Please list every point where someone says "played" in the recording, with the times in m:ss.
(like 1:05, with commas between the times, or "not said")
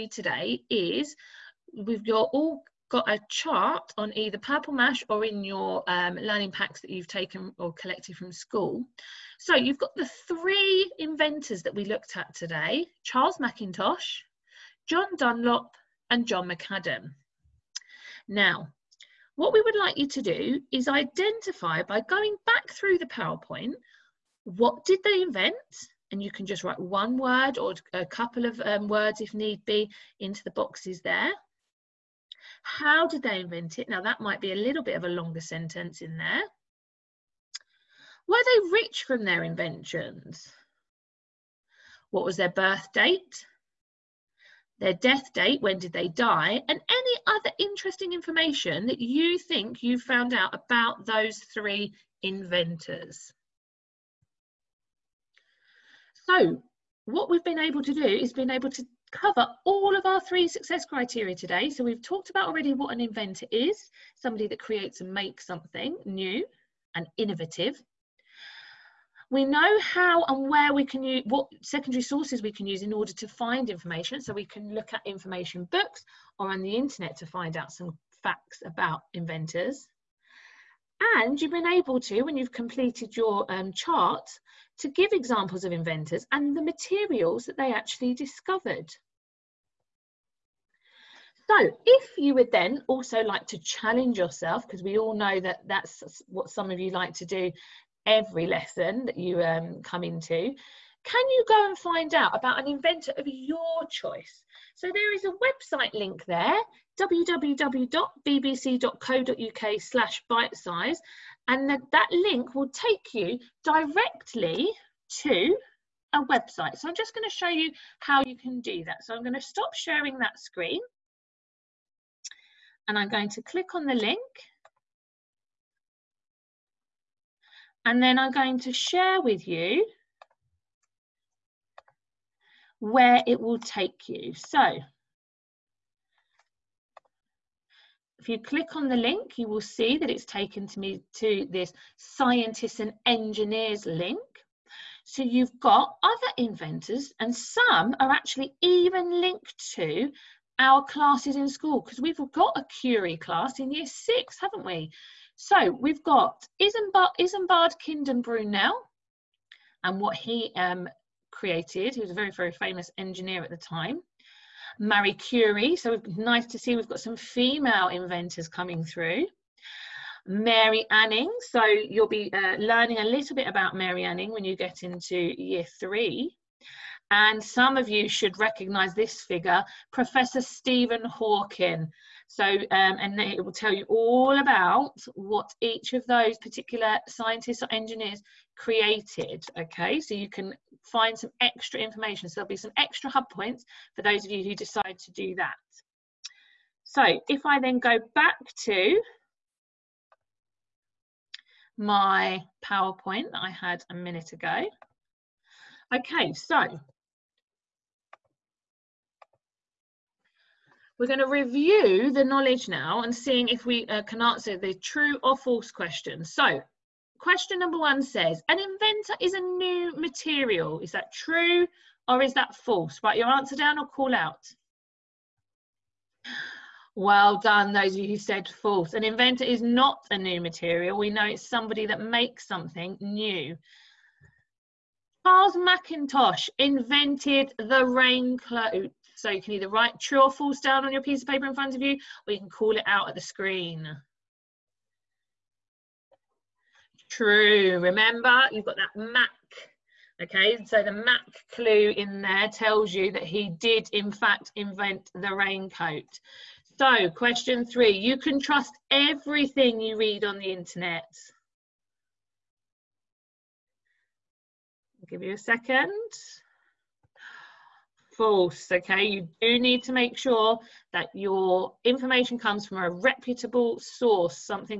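not said.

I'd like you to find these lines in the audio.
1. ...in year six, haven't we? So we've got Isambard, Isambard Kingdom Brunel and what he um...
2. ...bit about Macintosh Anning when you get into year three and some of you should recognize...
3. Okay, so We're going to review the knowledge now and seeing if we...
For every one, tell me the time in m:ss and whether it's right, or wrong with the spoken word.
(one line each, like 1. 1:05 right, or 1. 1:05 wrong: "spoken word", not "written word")
1. 2:33 right
2. 2:53 wrong: "Mary", not "Macintosh"
3. 3:25 right.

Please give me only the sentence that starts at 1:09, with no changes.
We know how and where we can use, what secondary sources we can use in order to find information.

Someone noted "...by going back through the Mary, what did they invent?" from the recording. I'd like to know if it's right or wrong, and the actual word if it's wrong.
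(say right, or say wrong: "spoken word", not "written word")
wrong: "PowerPoint", not "Mary".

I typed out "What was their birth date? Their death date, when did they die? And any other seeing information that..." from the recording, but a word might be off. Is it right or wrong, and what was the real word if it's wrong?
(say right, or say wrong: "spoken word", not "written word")
wrong: "interesting", not "seeing".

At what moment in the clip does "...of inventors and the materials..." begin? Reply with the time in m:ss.
1:25.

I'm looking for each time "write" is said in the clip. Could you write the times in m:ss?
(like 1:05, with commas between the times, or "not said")
0:26, 3:43, 3:59.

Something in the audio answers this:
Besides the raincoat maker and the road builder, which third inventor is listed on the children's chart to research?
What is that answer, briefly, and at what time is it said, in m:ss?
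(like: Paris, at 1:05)
John Dunlop, at 0:14.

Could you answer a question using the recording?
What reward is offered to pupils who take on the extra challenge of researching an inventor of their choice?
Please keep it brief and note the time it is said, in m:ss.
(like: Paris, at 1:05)
Hub points, at 3:13.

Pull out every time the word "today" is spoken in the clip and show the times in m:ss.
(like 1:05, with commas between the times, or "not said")
0:00, 0:12, 1:01.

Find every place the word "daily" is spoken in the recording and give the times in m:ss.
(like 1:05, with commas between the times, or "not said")
not said.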